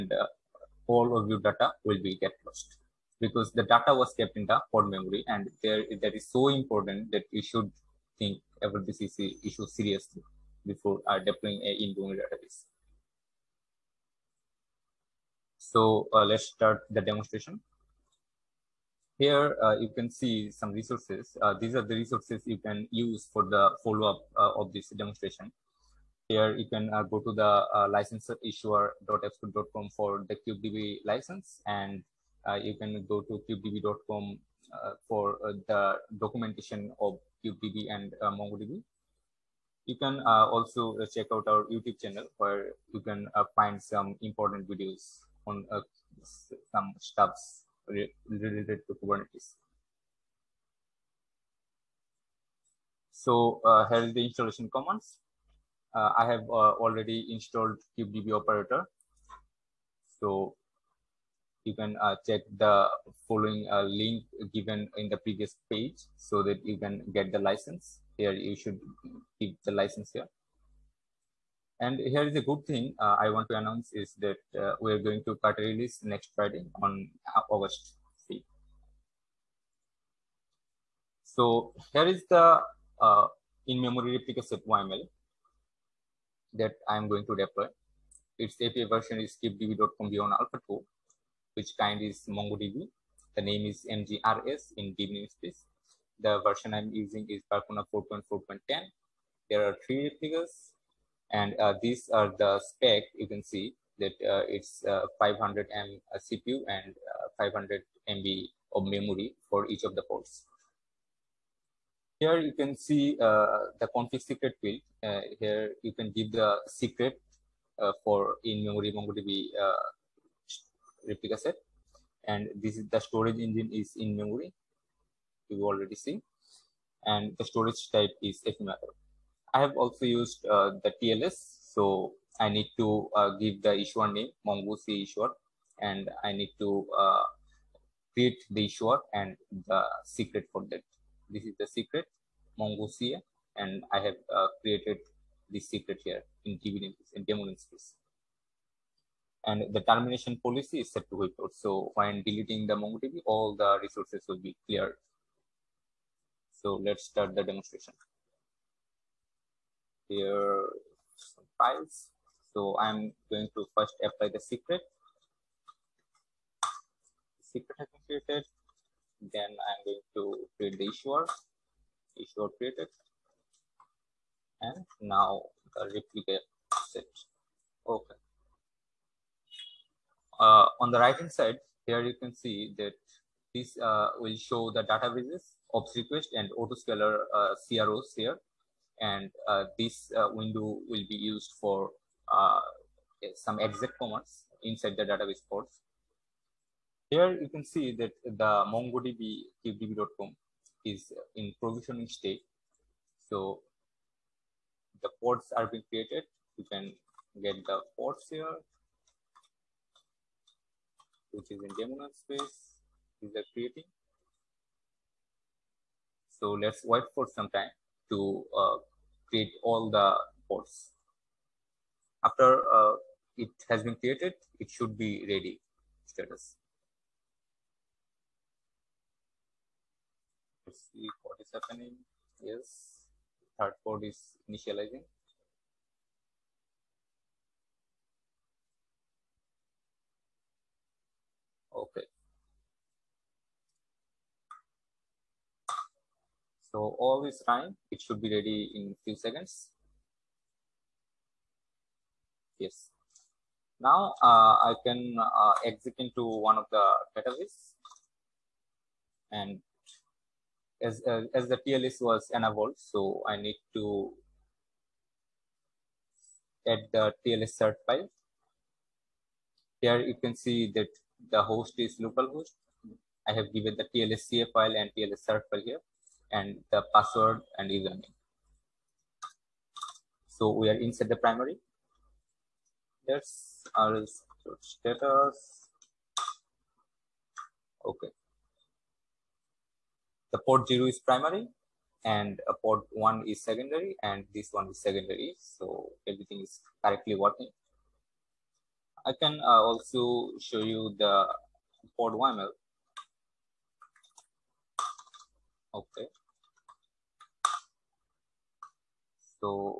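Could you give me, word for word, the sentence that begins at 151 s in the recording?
So when deleting the MongoDB, all the resources will be cleared.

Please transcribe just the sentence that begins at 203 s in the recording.
So the pods are being created.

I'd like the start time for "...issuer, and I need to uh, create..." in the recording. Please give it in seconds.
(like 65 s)
135 s.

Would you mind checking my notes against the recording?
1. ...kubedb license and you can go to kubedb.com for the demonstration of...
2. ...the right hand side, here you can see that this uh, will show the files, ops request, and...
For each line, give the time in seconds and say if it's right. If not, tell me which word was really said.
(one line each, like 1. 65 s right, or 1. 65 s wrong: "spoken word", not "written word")
1. 30 s wrong: "documentation", not "demonstration"
2. 180 s wrong: "databases", not "files".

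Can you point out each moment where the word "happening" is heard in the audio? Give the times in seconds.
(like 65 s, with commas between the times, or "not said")
231 s.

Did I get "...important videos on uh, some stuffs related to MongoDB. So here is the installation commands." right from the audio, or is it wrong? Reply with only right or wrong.
wrong.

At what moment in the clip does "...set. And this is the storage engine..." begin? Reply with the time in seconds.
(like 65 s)
121 s.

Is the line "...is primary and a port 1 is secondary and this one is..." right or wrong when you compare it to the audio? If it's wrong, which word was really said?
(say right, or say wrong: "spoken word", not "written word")
right.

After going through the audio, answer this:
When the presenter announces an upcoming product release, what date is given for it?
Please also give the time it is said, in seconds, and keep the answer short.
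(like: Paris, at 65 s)
August 5th, at 77 s.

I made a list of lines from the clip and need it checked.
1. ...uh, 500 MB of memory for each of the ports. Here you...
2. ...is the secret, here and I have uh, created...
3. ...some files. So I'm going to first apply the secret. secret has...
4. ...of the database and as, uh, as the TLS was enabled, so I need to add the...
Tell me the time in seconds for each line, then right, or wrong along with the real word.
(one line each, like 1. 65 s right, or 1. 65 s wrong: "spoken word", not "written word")
1. 107 s right
2. 141 s right
3. 161 s right
4. 256 s right.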